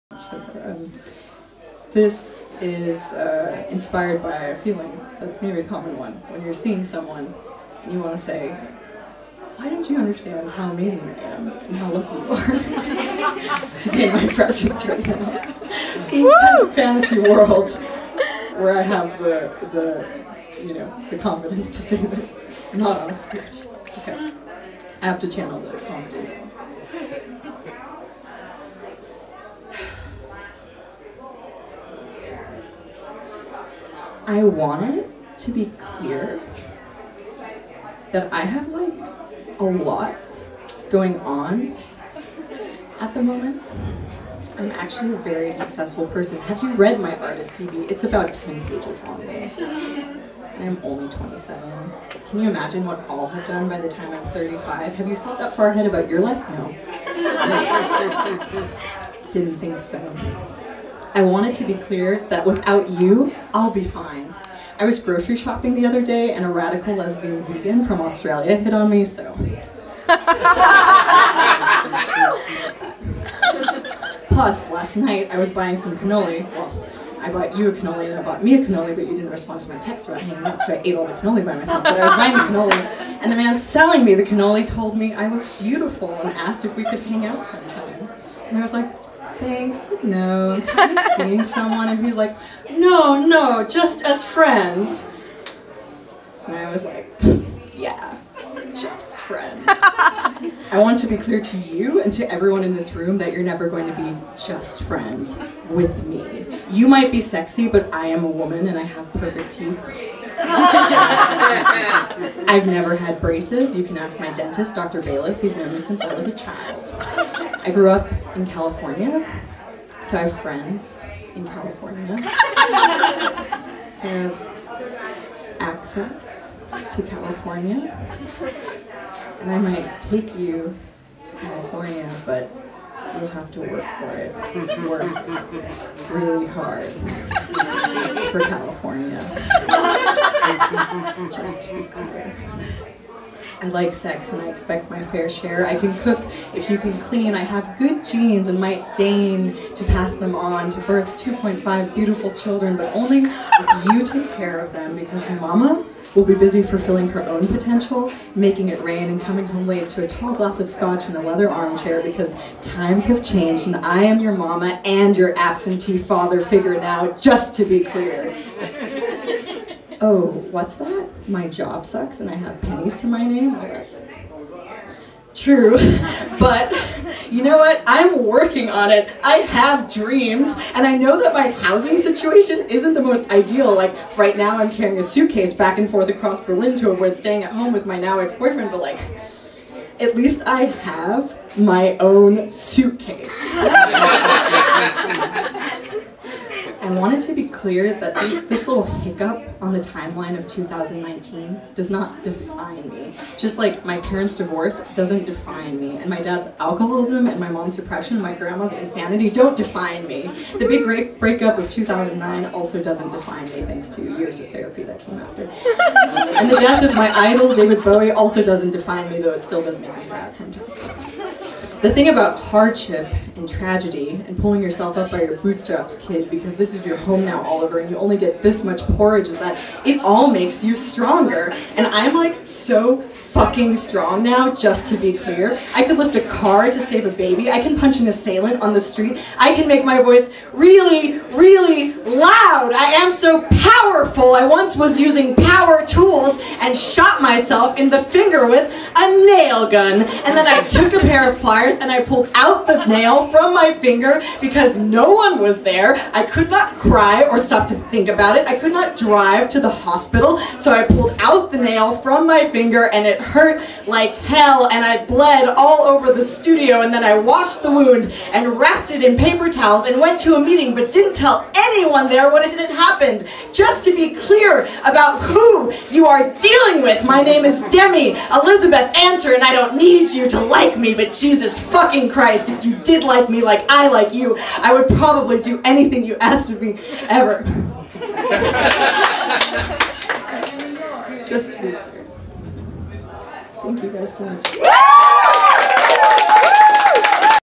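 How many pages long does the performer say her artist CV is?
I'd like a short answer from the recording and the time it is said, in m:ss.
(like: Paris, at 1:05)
10 pages, at 0:48.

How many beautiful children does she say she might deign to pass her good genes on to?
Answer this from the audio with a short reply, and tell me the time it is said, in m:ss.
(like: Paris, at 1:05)
2.5, at 2:31.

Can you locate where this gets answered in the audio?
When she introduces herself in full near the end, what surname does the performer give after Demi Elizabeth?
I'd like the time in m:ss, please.
4:38.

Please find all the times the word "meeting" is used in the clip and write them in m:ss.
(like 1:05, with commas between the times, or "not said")
4:30.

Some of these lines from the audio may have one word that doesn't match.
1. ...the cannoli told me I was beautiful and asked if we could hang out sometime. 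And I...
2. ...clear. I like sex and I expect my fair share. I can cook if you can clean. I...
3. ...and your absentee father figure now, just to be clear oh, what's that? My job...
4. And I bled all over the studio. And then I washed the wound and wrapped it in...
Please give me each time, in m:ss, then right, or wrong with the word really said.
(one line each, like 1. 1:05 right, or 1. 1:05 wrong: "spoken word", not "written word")
1. 1:24 right
2. 2:21 right
3. 2:44 right
4. 4:24 right.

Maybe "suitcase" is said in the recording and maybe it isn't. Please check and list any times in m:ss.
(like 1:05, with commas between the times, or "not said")
3:05, 3:12.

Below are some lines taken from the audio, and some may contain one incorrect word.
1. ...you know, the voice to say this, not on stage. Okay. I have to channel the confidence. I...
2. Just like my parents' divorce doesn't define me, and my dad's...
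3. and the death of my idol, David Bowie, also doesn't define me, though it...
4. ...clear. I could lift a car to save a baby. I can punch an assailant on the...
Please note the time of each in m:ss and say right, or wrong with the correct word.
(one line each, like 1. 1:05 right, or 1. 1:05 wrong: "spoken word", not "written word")
1. 0:20 wrong: "confidence", not "voice"
2. 3:23 right
3. 3:36 right
4. 3:55 right.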